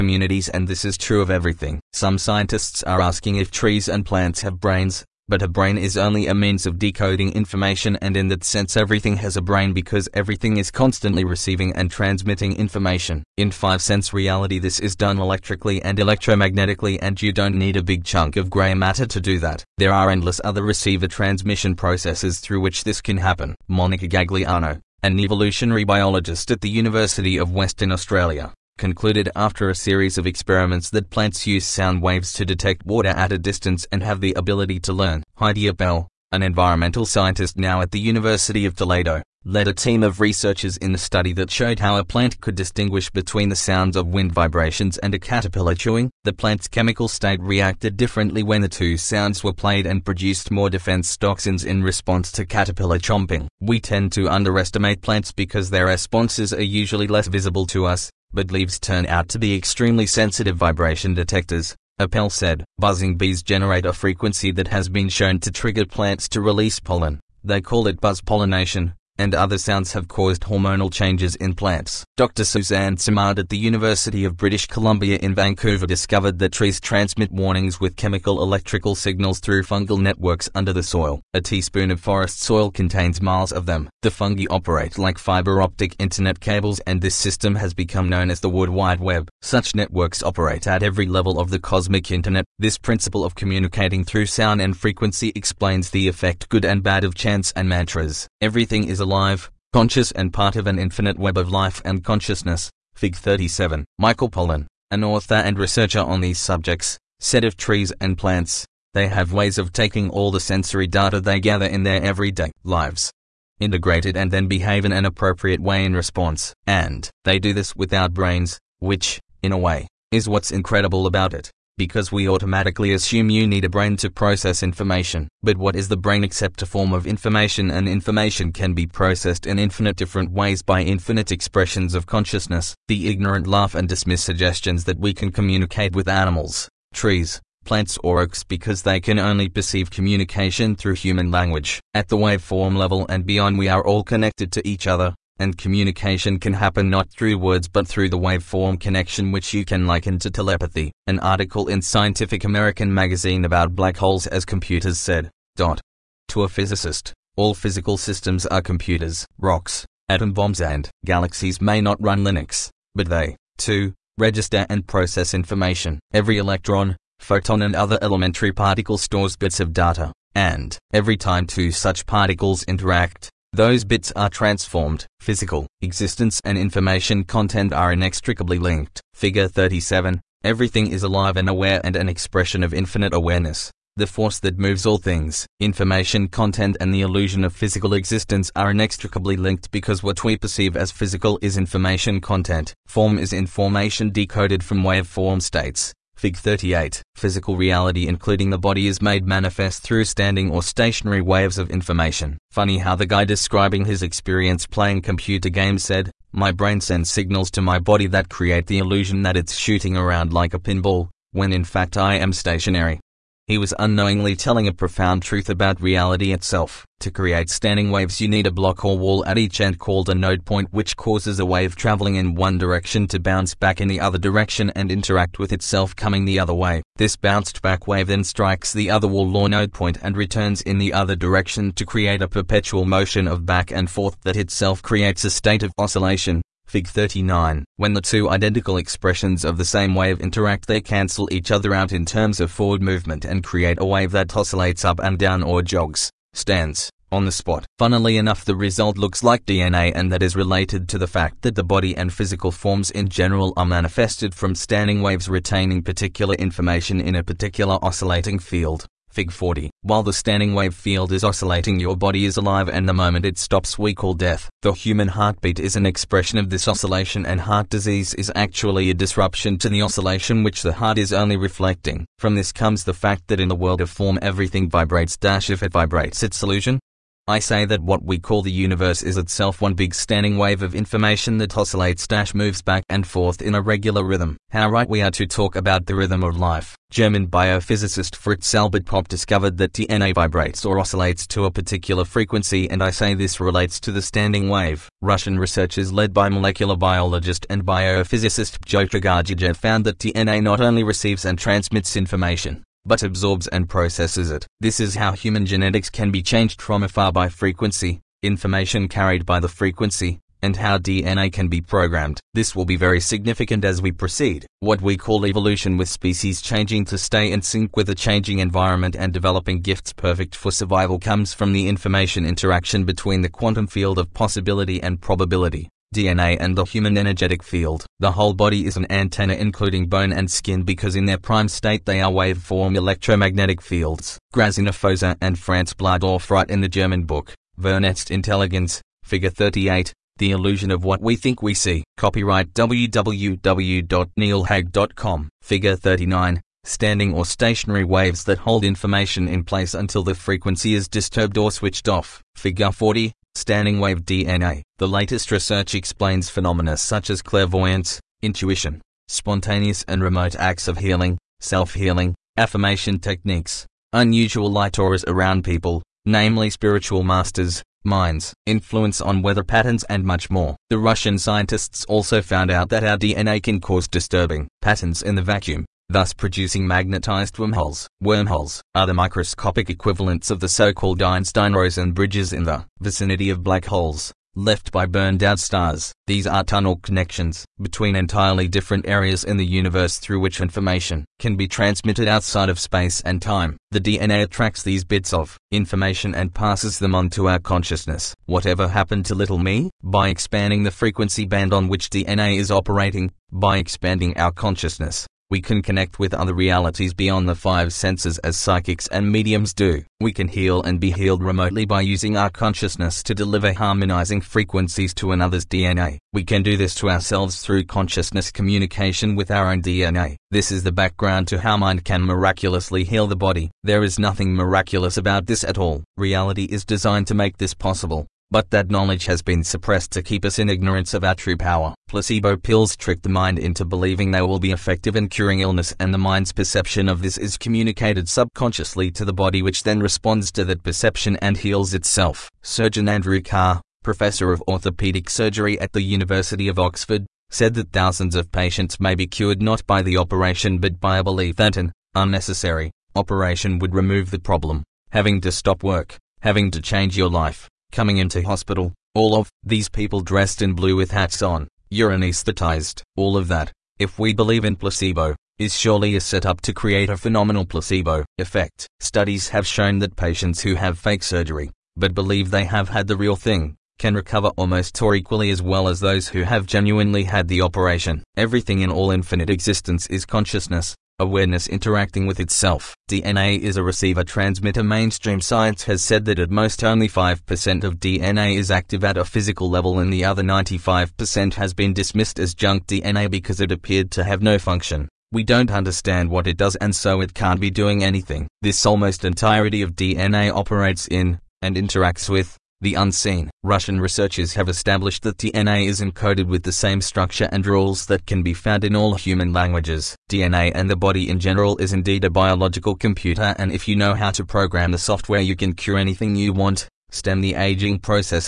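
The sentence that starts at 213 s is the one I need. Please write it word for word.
He was unknowingly telling a profound truth about reality itself.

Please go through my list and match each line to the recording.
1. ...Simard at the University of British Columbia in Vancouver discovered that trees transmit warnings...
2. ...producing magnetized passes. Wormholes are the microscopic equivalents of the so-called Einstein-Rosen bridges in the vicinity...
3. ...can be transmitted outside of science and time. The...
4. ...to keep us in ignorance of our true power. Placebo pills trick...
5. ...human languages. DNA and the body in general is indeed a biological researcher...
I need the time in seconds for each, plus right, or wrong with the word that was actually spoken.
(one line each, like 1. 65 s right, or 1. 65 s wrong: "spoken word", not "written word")
1. 72 s right
2. 376 s wrong: "wormholes", not "passes"
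3. 391 s wrong: "space", not "science"
4. 429 s right
5. 508 s wrong: "computer", not "researcher".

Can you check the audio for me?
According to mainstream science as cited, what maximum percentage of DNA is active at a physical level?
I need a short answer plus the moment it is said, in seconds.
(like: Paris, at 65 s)
5%, at 486 s.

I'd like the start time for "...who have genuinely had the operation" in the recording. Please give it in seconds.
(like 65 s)
476 s.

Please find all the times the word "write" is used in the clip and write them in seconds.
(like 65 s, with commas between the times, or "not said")
336 s.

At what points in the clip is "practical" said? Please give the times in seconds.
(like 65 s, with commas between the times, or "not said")
not said.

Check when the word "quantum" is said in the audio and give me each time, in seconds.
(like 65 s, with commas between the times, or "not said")
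323 s.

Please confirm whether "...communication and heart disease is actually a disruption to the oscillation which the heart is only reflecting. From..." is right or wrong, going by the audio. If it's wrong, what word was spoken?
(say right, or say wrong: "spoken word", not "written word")
wrong: "oscillation", not "communication".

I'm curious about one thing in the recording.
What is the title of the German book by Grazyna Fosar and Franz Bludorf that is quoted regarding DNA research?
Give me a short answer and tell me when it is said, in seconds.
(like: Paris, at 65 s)
Vernetzt Intelligence, at 337 s.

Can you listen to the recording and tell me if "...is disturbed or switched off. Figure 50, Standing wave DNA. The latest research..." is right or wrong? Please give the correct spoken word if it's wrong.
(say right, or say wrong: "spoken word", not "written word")
wrong: "40", not "50".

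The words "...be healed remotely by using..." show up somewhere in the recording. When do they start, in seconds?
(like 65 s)
410 s.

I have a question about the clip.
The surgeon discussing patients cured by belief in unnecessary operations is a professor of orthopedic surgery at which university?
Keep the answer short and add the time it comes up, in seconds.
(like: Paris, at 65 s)
University of Oxford, at 445 s.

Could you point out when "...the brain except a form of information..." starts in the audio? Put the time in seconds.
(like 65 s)
125 s.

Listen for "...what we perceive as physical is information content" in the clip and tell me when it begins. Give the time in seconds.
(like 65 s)
190 s.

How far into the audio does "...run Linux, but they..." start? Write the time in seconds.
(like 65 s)
162 s.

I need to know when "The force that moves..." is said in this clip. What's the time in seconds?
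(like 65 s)
183 s.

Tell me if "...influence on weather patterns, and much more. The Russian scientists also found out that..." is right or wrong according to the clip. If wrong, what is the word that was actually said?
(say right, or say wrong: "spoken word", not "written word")
right.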